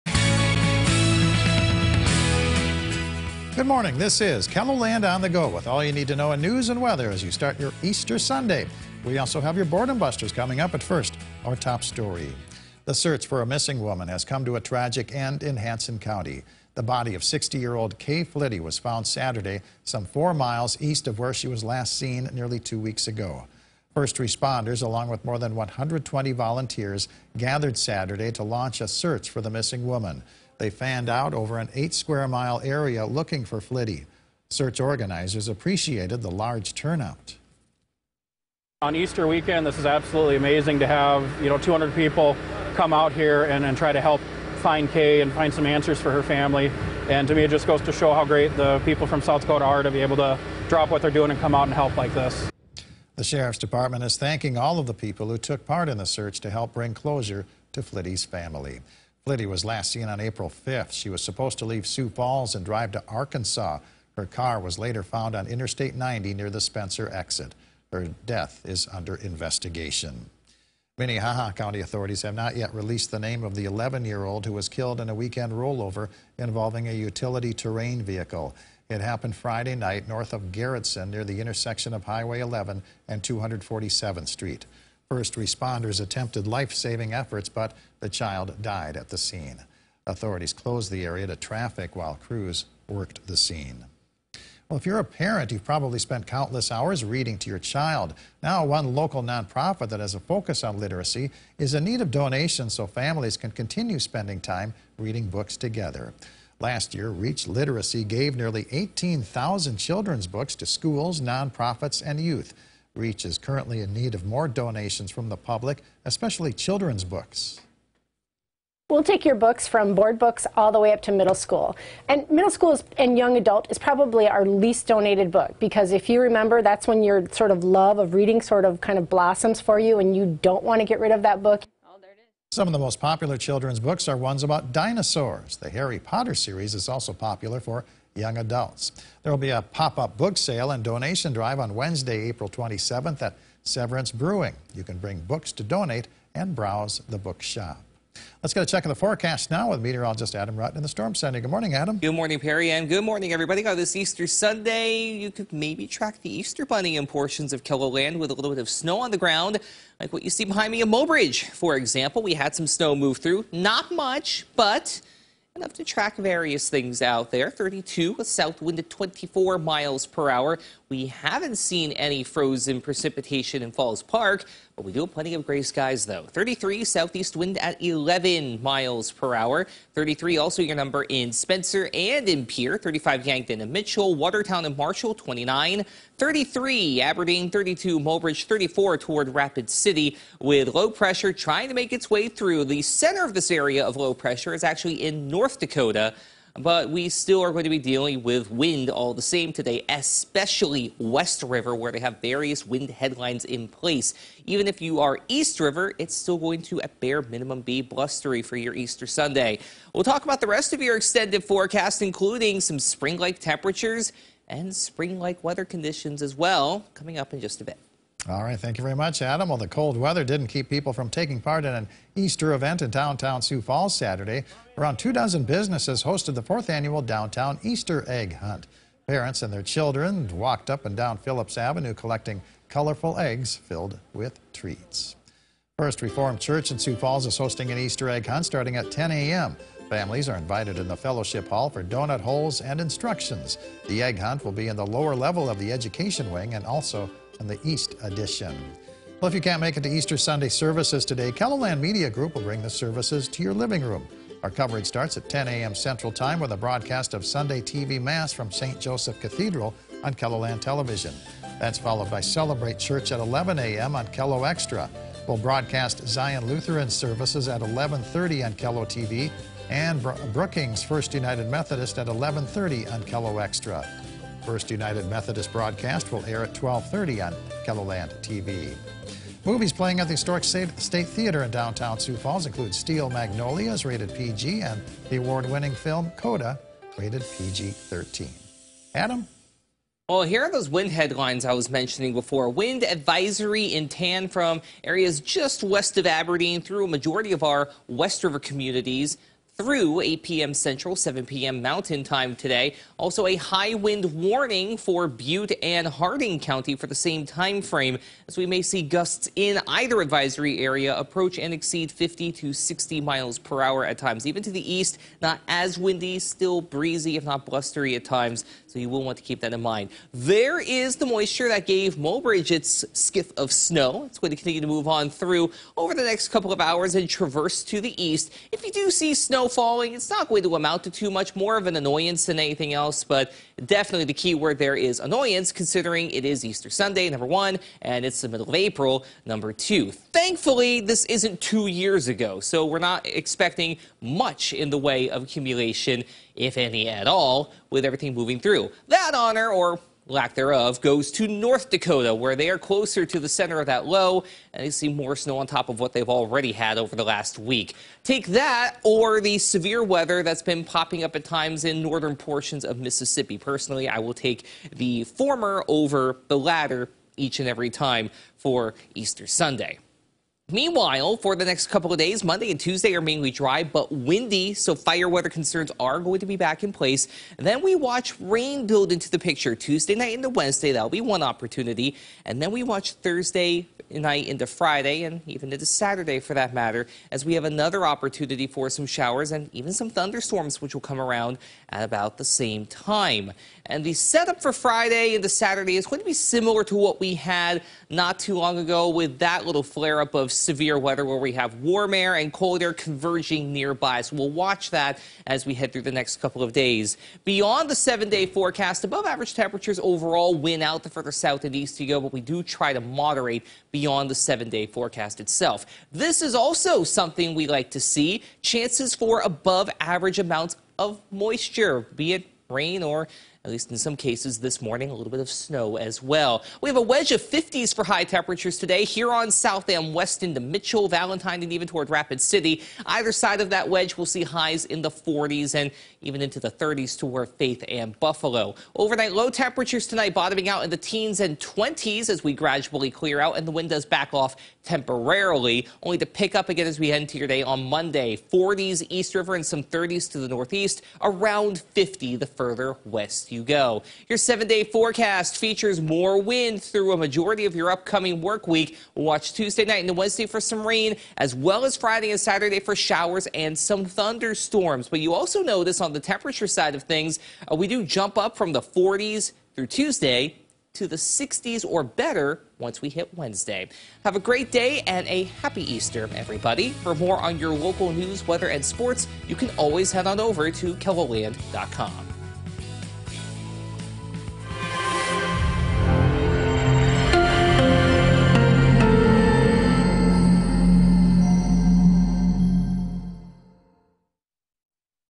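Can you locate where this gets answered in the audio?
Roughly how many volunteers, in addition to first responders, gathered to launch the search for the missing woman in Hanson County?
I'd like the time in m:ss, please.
0:25.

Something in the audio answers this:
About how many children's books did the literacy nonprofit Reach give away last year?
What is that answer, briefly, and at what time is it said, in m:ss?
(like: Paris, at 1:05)
18,000, at 1:48.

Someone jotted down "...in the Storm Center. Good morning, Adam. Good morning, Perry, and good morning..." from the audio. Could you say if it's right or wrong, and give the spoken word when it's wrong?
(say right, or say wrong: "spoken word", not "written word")
right.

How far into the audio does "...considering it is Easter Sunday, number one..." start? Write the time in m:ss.
5:35.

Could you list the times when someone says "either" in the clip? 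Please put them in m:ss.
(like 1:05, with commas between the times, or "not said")
5:09, 7:12.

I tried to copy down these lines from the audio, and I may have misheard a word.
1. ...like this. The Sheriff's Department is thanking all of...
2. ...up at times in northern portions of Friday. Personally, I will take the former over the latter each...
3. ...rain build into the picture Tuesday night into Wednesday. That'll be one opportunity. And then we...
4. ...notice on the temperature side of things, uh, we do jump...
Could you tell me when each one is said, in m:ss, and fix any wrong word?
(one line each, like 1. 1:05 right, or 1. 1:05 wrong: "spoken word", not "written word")
1. 0:51 right
2. 6:01 wrong: "Mississippi", not "Friday"
3. 6:18 right
4. 7:45 right.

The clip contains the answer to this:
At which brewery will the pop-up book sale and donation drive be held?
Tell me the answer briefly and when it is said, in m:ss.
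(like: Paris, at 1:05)
Severance Brewing, at 2:23.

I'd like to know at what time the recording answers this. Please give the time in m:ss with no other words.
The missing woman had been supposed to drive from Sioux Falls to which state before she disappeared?
1:03.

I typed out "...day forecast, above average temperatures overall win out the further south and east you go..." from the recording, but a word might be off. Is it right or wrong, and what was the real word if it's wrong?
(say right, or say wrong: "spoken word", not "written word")
right.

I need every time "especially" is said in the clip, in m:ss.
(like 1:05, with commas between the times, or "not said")
1:56, 3:19.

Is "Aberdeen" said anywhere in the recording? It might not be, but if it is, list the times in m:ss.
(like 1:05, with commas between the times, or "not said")
3:07, 4:56.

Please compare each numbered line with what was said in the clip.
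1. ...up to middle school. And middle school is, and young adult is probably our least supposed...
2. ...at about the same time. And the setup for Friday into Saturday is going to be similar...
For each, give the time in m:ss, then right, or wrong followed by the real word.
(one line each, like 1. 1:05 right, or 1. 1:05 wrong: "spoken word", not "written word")
1. 2:00 wrong: "donated", not "supposed"
2. 6:31 right.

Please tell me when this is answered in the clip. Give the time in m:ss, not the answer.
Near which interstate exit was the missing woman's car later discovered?
1:06.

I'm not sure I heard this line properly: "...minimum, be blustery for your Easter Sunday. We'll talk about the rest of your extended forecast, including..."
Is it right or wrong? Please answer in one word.
right.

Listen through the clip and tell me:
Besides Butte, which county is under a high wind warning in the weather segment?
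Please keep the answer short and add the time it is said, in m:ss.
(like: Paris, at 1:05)
Harding County, at 5:05.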